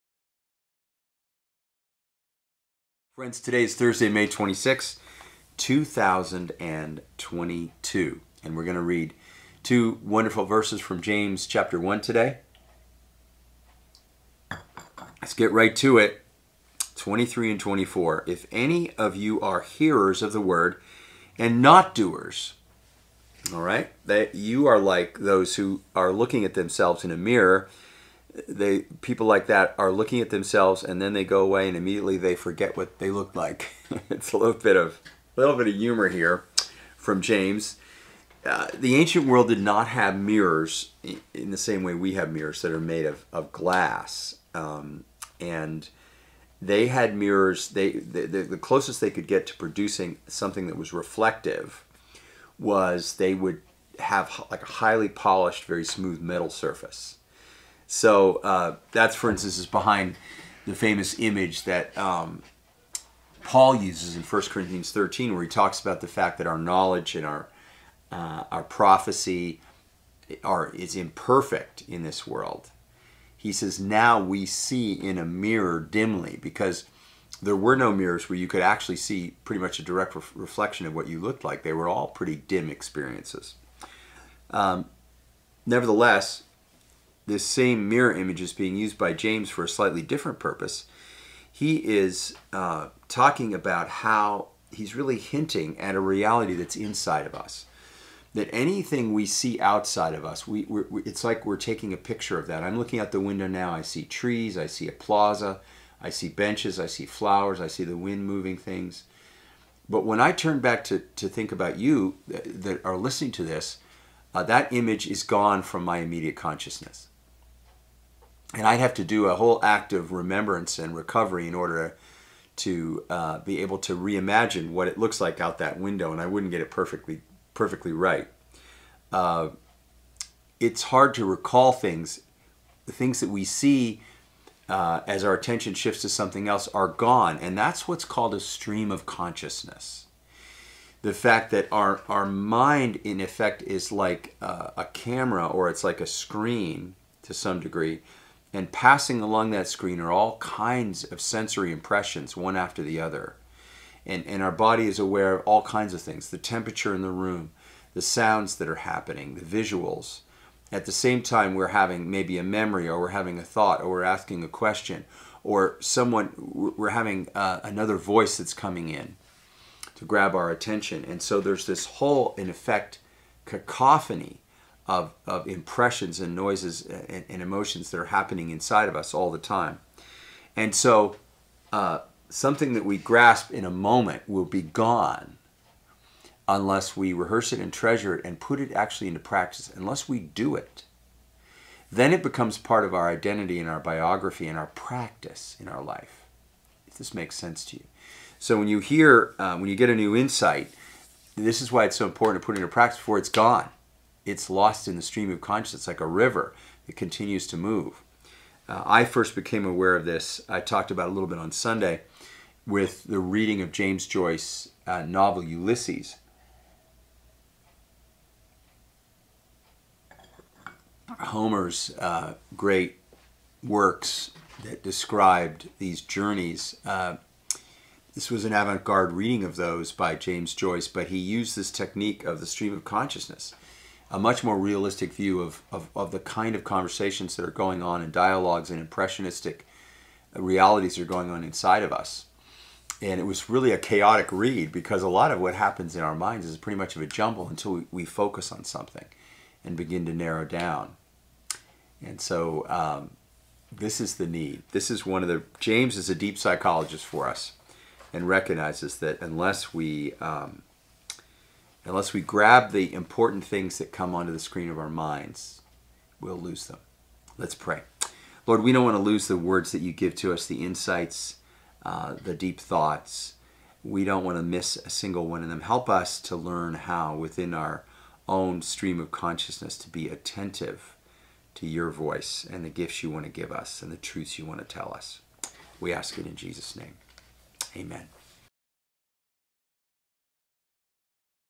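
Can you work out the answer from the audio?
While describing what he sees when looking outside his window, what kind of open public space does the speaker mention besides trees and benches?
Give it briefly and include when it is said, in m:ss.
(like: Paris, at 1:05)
A plaza, at 1:44.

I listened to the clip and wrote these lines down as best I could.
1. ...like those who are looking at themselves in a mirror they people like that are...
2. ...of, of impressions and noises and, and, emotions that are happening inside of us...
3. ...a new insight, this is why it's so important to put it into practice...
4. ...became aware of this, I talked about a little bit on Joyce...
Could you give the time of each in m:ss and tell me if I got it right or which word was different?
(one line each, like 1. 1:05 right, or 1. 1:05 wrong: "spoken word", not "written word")
1. 0:24 right
2. 2:54 right
3. 3:19 right
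4. 3:29 wrong: "Sunday", not "Joyce".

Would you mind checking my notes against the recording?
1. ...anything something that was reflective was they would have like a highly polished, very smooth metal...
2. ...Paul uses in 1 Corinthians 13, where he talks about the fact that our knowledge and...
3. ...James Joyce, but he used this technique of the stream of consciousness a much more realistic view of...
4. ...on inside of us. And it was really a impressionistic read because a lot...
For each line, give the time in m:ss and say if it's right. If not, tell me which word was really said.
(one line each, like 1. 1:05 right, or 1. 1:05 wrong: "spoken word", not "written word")
1. 0:49 wrong: "producing", not "anything"
2. 1:03 right
3. 3:50 right
4. 4:01 wrong: "chaotic", not "impressionistic".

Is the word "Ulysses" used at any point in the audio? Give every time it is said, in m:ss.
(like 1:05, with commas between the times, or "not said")
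3:35.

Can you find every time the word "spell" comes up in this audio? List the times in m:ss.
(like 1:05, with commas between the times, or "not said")
not said.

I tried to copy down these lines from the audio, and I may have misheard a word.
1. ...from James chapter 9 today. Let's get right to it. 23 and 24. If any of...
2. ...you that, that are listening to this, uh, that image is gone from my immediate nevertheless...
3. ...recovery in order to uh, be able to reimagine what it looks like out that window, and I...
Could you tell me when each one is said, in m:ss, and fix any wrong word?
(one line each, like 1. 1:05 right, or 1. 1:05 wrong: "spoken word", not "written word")
1. 0:10 wrong: "1", not "9"
2. 1:51 wrong: "consciousness", not "nevertheless"
3. 2:00 right.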